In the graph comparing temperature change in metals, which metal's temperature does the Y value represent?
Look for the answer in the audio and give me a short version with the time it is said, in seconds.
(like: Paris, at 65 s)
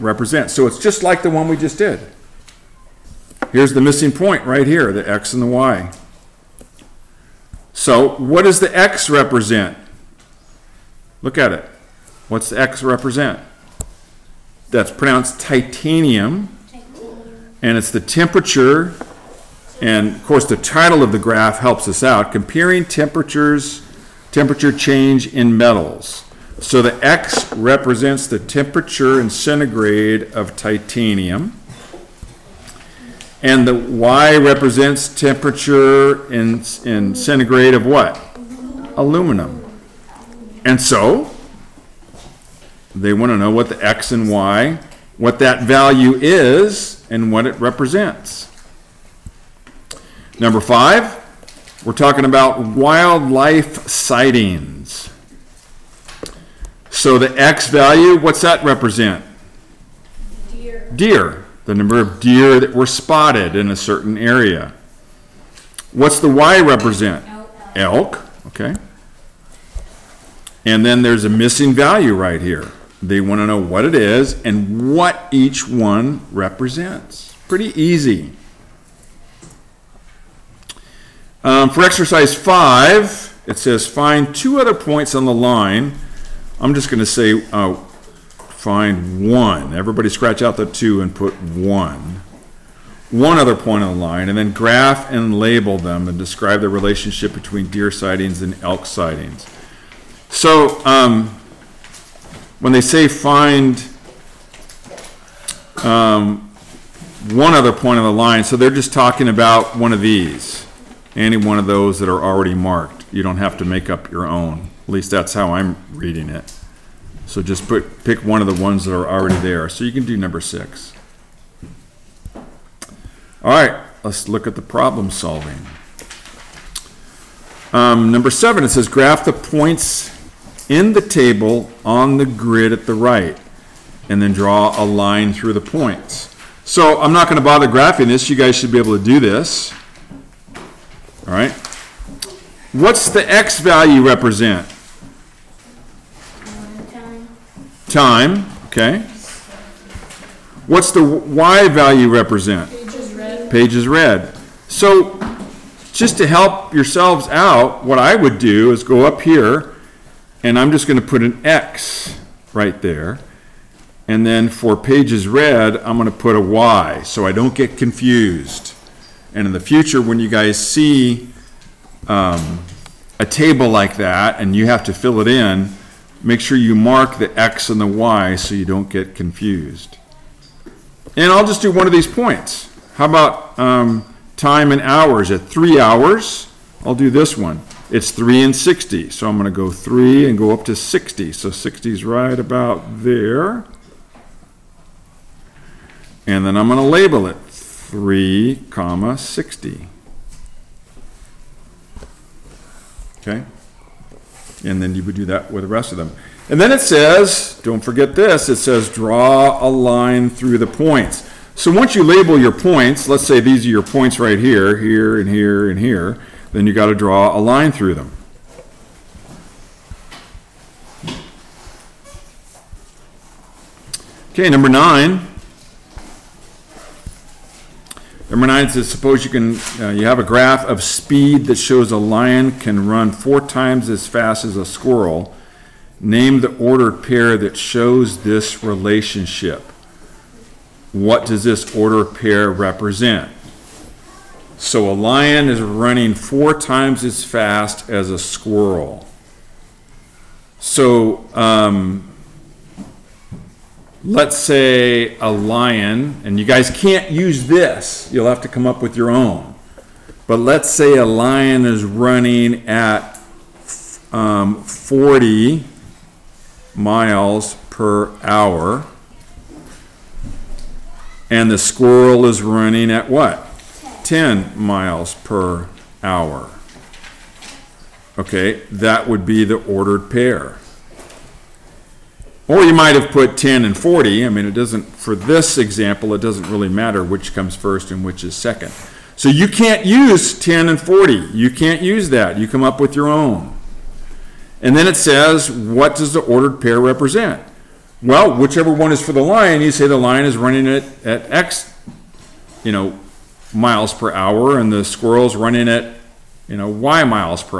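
Aluminum, at 38 s.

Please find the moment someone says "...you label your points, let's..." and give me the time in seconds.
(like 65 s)
211 s.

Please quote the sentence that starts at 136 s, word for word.
So I'm not going to bother graphing this.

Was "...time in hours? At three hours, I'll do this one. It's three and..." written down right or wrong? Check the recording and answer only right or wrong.
right.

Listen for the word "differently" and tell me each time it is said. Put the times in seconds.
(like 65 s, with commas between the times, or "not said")
not said.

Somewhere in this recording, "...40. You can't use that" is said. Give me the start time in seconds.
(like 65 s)
290 s.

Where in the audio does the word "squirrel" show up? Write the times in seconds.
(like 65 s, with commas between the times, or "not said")
234 s, 248 s, 271 s, 304 s.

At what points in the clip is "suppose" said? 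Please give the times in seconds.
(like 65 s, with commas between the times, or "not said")
228 s.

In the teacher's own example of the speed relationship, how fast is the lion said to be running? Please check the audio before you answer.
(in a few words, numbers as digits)
40 miles per hour.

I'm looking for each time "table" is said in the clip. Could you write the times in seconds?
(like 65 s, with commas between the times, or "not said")
130 s, 173 s.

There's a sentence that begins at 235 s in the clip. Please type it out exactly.
Name the ordered pair that shows this relationship.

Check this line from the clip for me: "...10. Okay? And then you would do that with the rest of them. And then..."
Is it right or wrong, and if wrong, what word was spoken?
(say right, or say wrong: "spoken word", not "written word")
wrong: "60", not "10".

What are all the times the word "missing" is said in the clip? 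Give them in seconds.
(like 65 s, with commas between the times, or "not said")
3 s, 71 s.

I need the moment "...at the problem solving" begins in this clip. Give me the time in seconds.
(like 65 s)
124 s.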